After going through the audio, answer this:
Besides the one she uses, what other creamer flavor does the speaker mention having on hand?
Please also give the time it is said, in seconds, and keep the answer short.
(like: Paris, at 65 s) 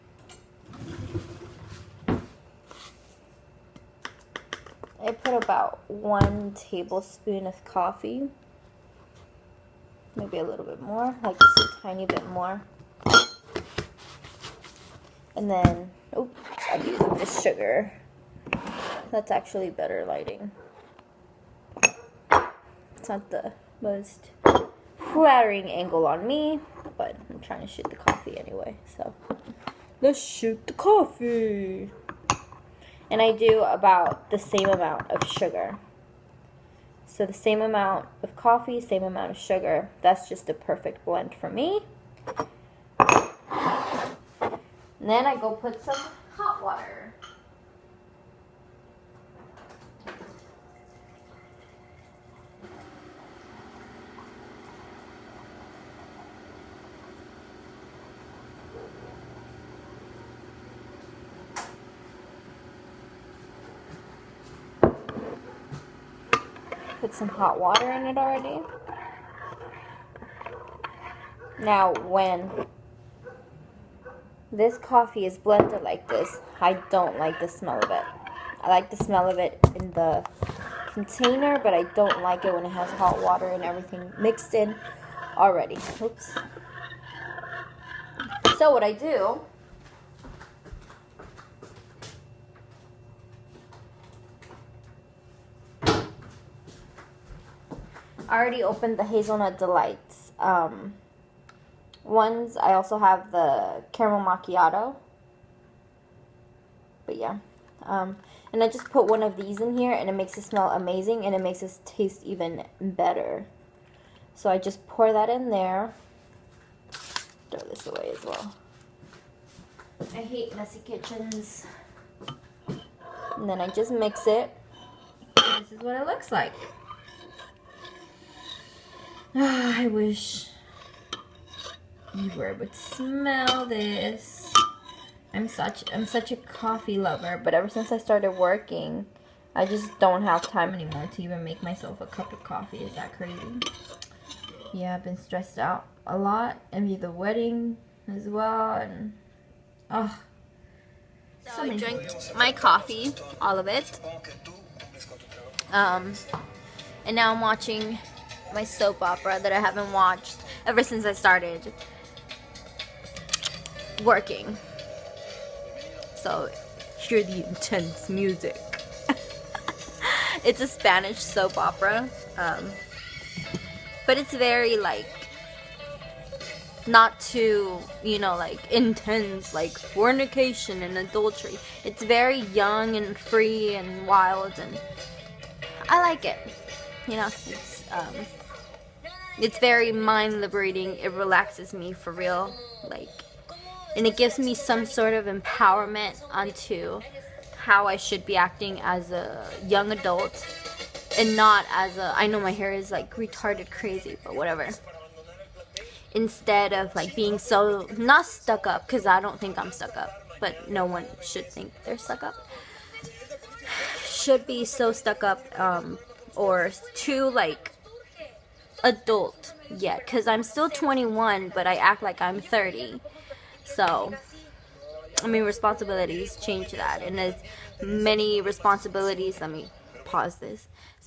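Caramel macchiato, at 103 s.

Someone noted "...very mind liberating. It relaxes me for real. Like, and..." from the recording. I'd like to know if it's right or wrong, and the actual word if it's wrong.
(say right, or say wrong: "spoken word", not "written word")
right.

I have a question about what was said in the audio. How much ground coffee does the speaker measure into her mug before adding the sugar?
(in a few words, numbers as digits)
1 tablespoon.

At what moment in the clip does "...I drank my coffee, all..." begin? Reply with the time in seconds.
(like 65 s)
151 s.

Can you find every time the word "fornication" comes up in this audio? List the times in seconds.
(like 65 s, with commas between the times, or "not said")
179 s.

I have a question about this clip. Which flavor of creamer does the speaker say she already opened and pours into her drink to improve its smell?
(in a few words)
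Hazelnut delights.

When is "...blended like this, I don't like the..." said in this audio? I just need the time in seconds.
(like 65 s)
75 s.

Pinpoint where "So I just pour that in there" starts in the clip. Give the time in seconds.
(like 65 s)
114 s.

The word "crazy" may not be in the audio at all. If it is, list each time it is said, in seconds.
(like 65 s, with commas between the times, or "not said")
143 s, 203 s.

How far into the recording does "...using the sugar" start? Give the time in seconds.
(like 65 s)
16 s.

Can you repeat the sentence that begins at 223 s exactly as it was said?
So, I mean, responsibilities change that.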